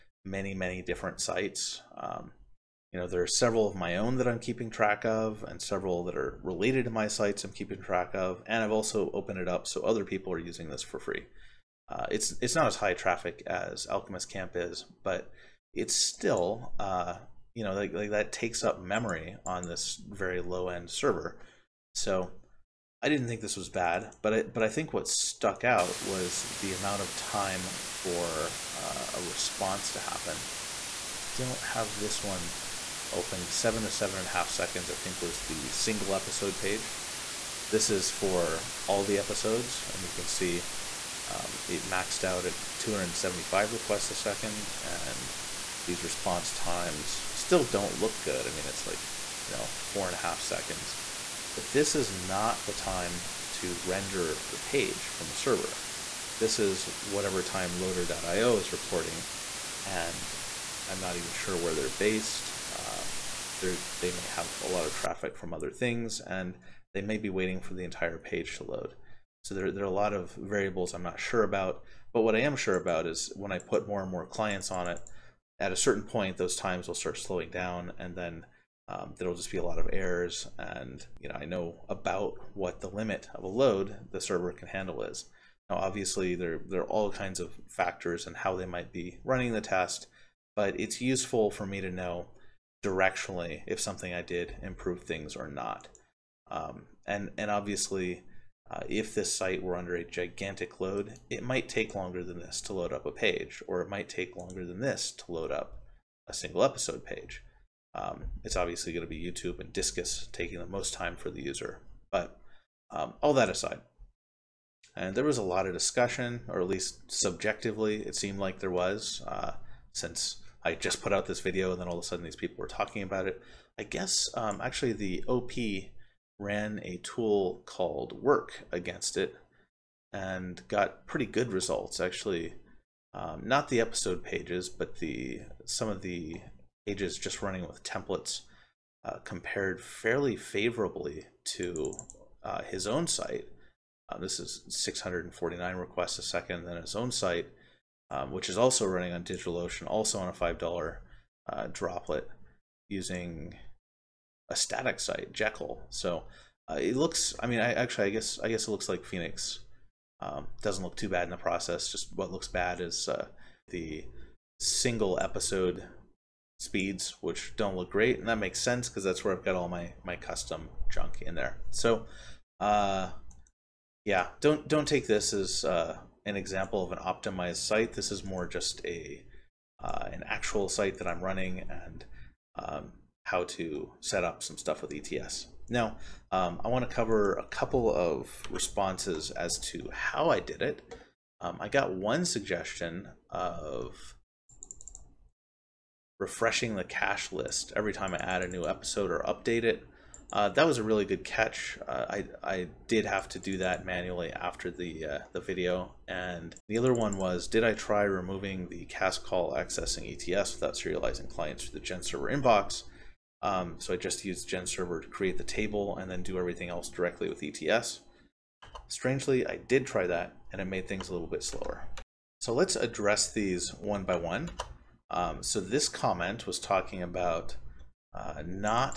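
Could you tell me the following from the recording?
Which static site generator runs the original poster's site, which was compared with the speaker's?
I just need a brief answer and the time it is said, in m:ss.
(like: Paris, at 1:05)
Jekyll, at 2:35.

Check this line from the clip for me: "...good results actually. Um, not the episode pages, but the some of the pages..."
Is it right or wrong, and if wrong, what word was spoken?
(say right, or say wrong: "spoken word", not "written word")
right.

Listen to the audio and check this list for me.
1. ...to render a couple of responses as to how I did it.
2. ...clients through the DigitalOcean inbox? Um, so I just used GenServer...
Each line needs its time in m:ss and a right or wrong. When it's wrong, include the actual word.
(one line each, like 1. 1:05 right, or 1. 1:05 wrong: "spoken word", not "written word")
1. 3:06 wrong: "cover", not "render"
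2. 3:31 wrong: "GenServer", not "DigitalOcean".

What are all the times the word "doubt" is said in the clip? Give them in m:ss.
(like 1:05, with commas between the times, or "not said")
not said.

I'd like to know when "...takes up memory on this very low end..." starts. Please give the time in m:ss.
0:18.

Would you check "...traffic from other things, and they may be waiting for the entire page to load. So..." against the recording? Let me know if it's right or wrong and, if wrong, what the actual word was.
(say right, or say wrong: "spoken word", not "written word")
right.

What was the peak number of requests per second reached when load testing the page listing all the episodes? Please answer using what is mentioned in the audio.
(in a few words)
275.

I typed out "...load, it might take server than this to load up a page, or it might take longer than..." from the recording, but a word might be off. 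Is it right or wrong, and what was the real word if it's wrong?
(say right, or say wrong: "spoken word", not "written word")
wrong: "longer", not "server".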